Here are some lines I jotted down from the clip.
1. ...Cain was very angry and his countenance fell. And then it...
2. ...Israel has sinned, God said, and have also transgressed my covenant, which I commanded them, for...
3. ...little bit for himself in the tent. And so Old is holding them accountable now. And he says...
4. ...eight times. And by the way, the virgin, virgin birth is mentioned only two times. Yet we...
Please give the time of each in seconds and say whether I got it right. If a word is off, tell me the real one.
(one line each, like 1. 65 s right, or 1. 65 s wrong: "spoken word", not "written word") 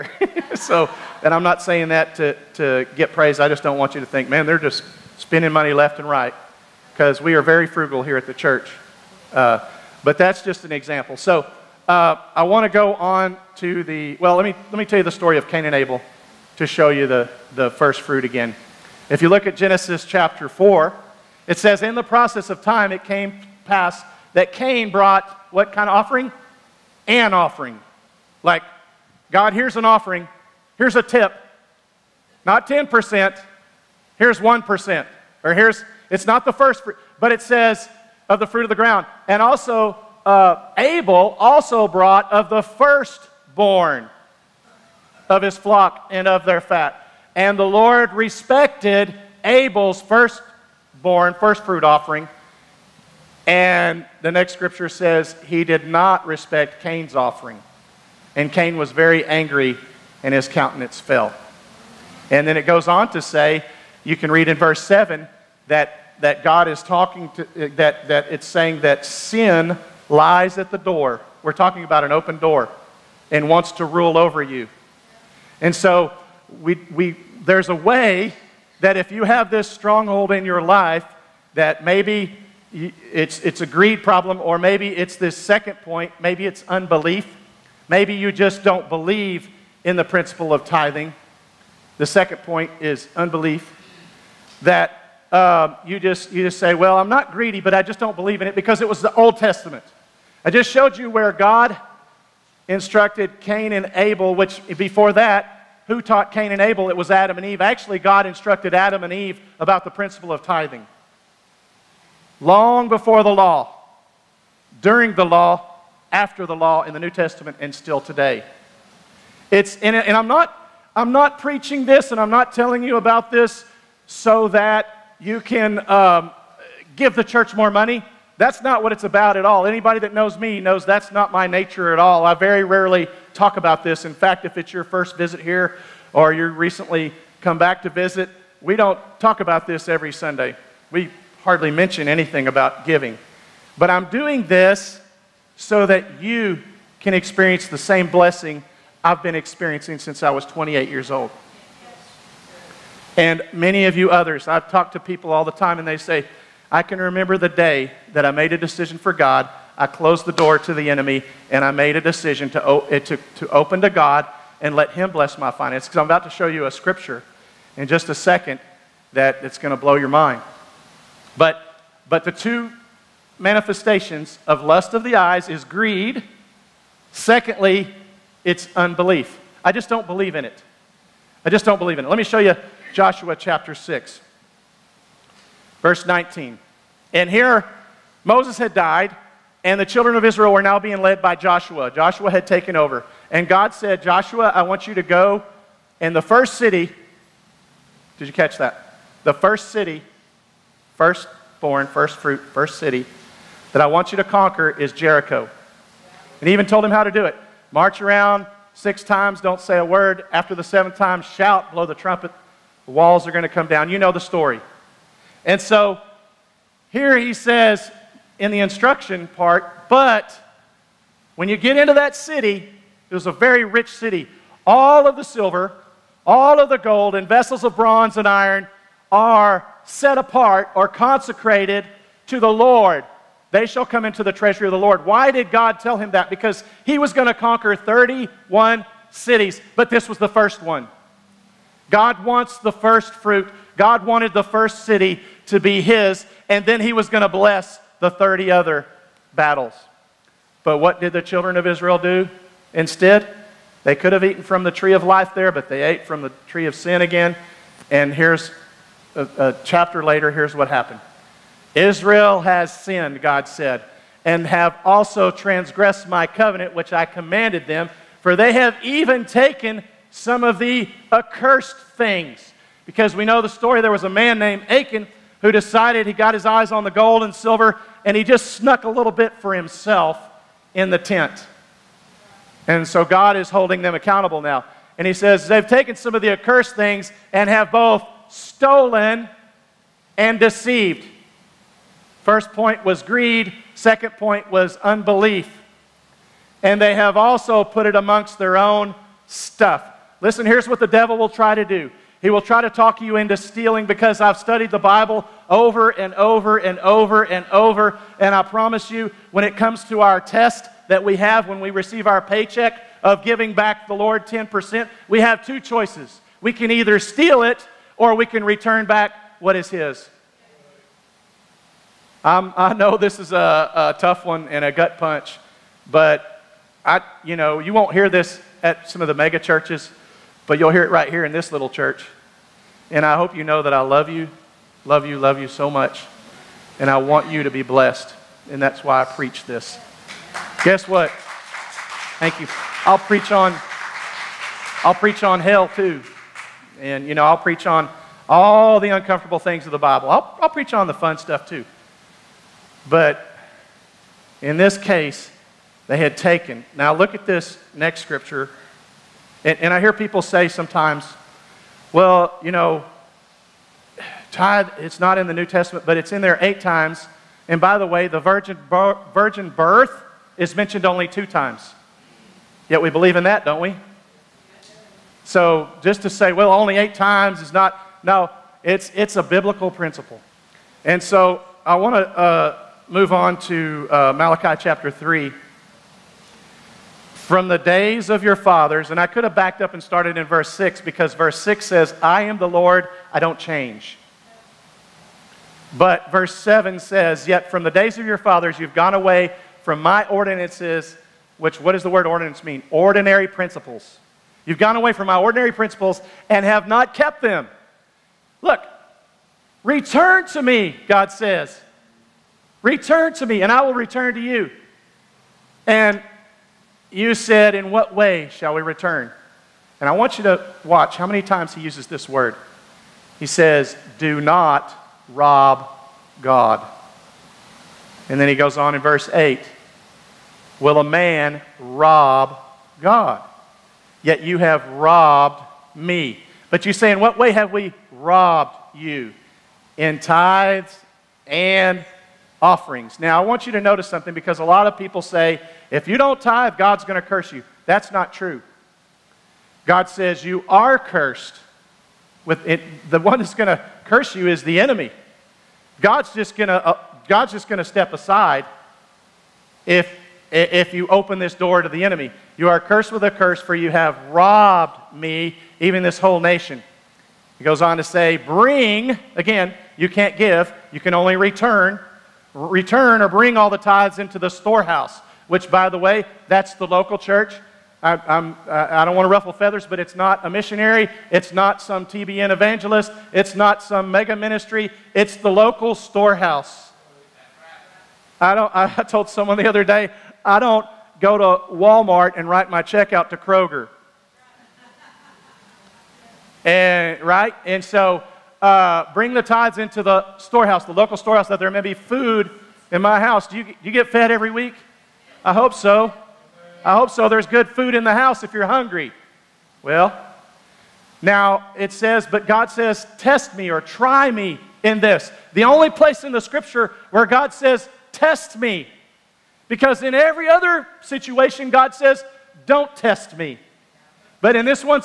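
1. 58 s right
2. 261 s right
3. 278 s wrong: "God", not "Old"
4. 366 s right.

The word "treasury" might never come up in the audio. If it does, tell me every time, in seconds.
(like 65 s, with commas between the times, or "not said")
234 s.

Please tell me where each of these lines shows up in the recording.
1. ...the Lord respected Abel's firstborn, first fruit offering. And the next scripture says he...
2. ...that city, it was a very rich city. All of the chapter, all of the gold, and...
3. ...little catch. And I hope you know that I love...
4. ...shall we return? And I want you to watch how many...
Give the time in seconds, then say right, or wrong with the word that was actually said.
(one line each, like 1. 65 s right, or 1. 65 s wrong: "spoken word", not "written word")
1. 47 s right
2. 221 s wrong: "silver", not "chapter"
3. 331 s wrong: "church", not "catch"
4. 418 s right.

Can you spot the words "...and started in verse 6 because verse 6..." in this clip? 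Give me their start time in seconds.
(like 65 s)
389 s.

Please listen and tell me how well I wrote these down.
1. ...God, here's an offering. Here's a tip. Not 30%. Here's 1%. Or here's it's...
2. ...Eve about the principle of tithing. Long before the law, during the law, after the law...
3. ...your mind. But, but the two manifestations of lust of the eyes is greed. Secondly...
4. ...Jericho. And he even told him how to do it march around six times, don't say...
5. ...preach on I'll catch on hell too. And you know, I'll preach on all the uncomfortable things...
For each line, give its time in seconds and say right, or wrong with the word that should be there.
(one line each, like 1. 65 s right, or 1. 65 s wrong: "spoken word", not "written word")
1. 29 s wrong: "10", not "30"
2. 109 s right
3. 169 s right
4. 204 s right
5. 342 s wrong: "preach", not "catch".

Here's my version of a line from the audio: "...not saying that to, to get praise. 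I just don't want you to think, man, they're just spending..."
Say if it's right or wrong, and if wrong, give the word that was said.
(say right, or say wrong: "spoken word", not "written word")
right.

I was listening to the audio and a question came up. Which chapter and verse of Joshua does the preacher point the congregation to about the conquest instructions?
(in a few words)
Joshua 6:19.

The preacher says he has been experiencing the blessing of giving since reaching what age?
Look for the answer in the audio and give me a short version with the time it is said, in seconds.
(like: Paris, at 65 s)
28, at 150 s.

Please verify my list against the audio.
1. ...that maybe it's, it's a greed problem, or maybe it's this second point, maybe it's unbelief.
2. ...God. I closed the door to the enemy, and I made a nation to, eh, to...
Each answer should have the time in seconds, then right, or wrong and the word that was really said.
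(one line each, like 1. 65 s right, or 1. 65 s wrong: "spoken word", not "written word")
1. 81 s right
2. 159 s wrong: "decision", not "nation".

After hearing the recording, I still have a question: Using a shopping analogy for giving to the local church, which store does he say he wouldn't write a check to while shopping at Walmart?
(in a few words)
Kroger.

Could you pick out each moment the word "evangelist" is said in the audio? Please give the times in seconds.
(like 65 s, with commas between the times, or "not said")
482 s.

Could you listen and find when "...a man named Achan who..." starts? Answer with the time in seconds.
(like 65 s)
274 s.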